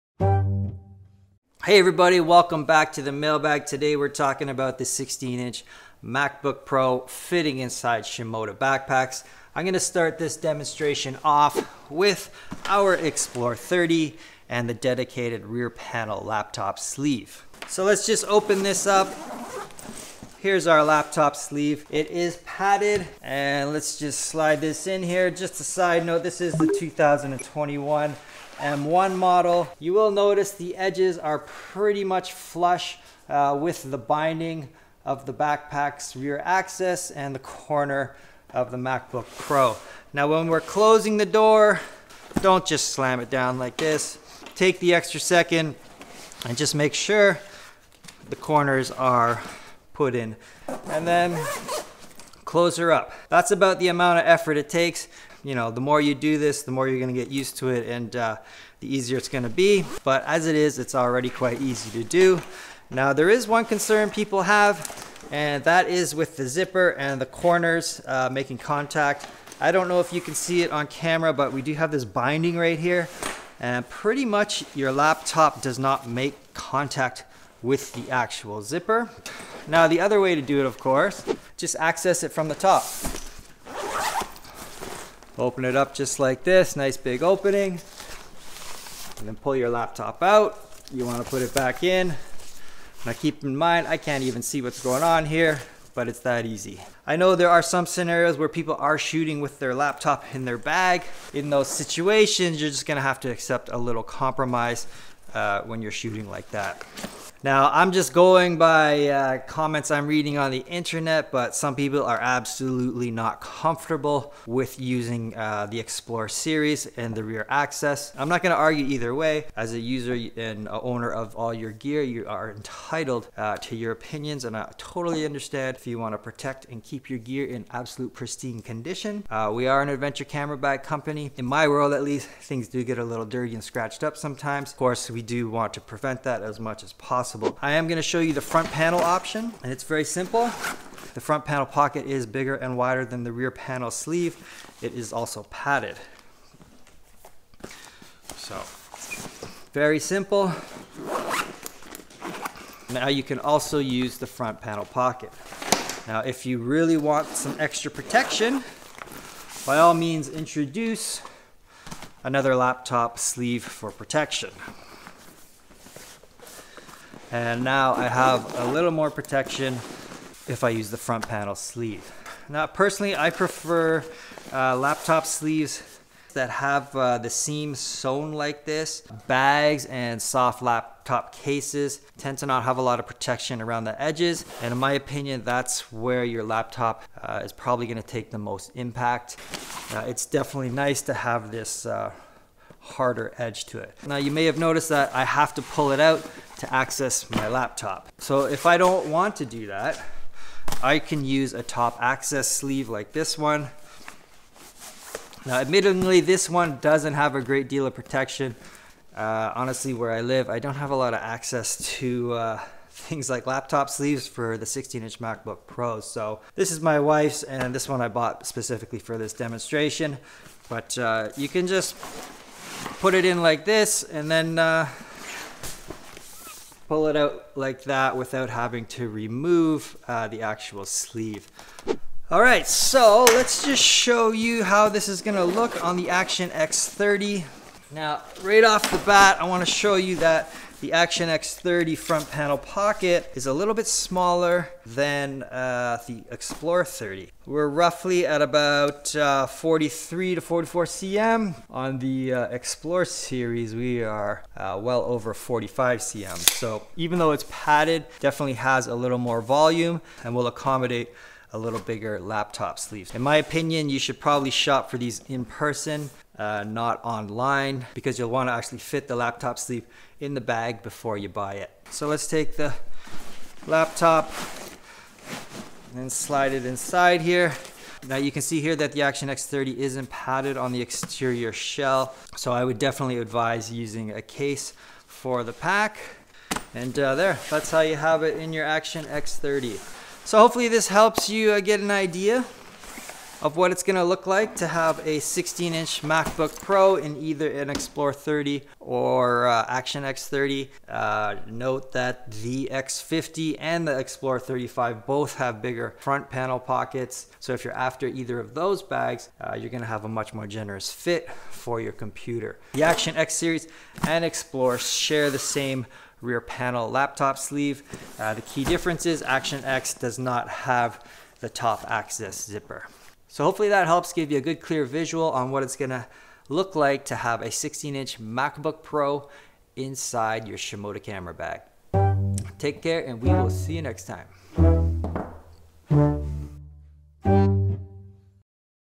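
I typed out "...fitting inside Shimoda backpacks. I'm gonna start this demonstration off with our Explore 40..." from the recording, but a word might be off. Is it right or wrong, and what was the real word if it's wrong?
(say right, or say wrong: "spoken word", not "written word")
wrong: "30", not "40".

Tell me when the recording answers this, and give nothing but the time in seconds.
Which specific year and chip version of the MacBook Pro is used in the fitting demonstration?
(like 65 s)
26 s.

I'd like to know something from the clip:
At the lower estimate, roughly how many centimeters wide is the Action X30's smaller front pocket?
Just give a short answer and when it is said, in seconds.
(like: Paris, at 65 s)
43 cm, at 249 s.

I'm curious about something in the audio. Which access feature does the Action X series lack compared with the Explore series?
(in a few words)
top access zipper.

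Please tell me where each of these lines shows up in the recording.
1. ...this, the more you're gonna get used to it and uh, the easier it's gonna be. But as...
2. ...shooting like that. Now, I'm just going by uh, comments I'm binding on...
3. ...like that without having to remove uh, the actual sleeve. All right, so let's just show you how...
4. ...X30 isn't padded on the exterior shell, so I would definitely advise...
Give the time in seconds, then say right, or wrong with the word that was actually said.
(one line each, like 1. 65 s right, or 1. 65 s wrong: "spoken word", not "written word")
1. 56 s right
2. 105 s wrong: "reading", not "binding"
3. 227 s right
4. 279 s right.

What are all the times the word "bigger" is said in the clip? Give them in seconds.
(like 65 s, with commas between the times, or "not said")
142 s, 261 s, 305 s.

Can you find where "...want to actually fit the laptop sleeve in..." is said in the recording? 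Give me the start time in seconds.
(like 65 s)
268 s.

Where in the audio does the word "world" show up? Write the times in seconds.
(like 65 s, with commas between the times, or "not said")
131 s.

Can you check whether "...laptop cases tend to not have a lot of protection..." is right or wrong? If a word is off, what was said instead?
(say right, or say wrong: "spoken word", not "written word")
right.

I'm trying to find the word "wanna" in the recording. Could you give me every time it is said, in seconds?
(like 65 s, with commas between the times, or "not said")
91 s, 239 s.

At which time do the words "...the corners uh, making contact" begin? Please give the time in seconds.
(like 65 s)
67 s.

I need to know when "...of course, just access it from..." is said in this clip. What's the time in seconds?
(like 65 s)
80 s.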